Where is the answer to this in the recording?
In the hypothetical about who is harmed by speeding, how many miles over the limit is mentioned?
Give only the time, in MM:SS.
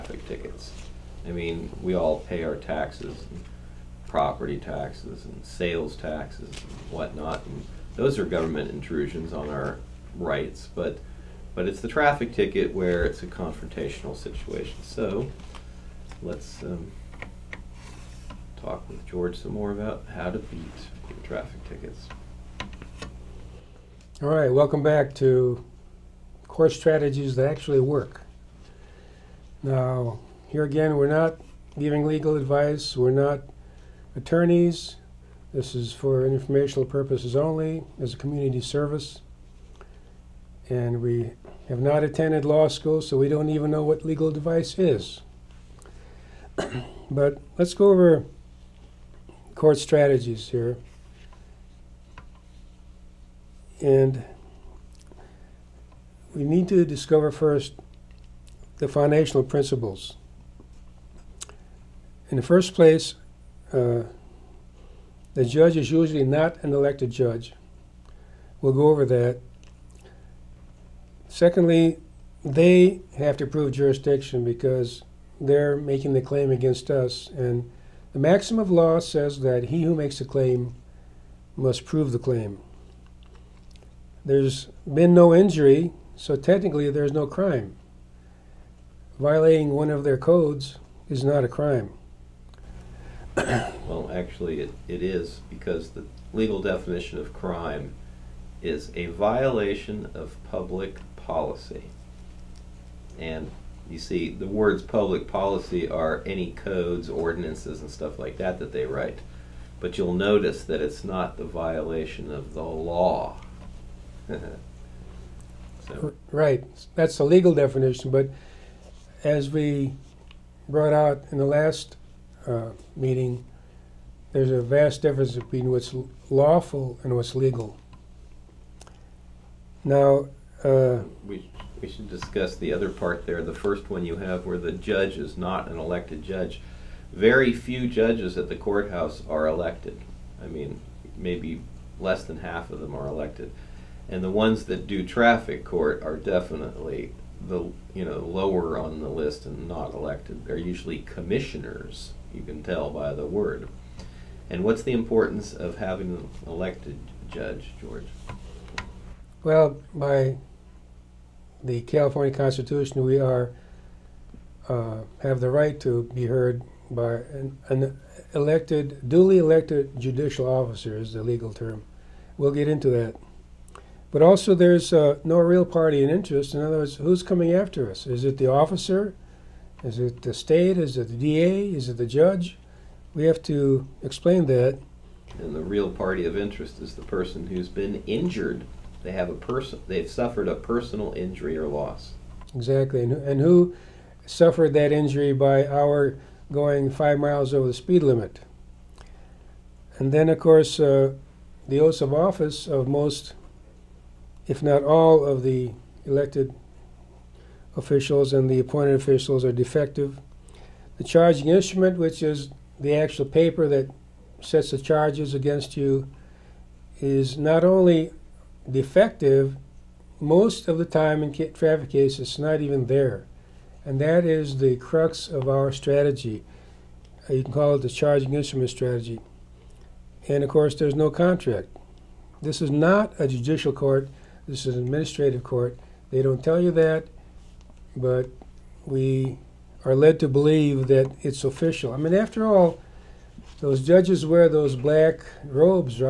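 03:16.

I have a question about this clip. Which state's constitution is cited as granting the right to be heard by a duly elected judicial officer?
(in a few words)
California.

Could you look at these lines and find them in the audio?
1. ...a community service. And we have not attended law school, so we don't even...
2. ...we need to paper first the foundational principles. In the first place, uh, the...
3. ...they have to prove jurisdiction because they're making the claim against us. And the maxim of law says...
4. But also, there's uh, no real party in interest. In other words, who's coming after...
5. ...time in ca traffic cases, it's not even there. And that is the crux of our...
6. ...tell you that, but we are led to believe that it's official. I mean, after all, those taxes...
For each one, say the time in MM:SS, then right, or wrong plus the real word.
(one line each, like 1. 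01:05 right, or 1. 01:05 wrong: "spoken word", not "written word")
1. 00:38 right
2. 00:56 wrong: "discover", not "paper"
3. 01:12 right
4. 02:54 right
5. 03:40 right
6. 03:56 wrong: "judges", not "taxes".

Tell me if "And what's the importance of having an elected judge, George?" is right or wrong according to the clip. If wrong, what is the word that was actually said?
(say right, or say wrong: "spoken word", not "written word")
right.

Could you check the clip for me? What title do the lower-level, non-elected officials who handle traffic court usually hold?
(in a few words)
Commissioners.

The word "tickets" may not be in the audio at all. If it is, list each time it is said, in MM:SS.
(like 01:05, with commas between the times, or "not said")
00:00, 00:12, 00:21.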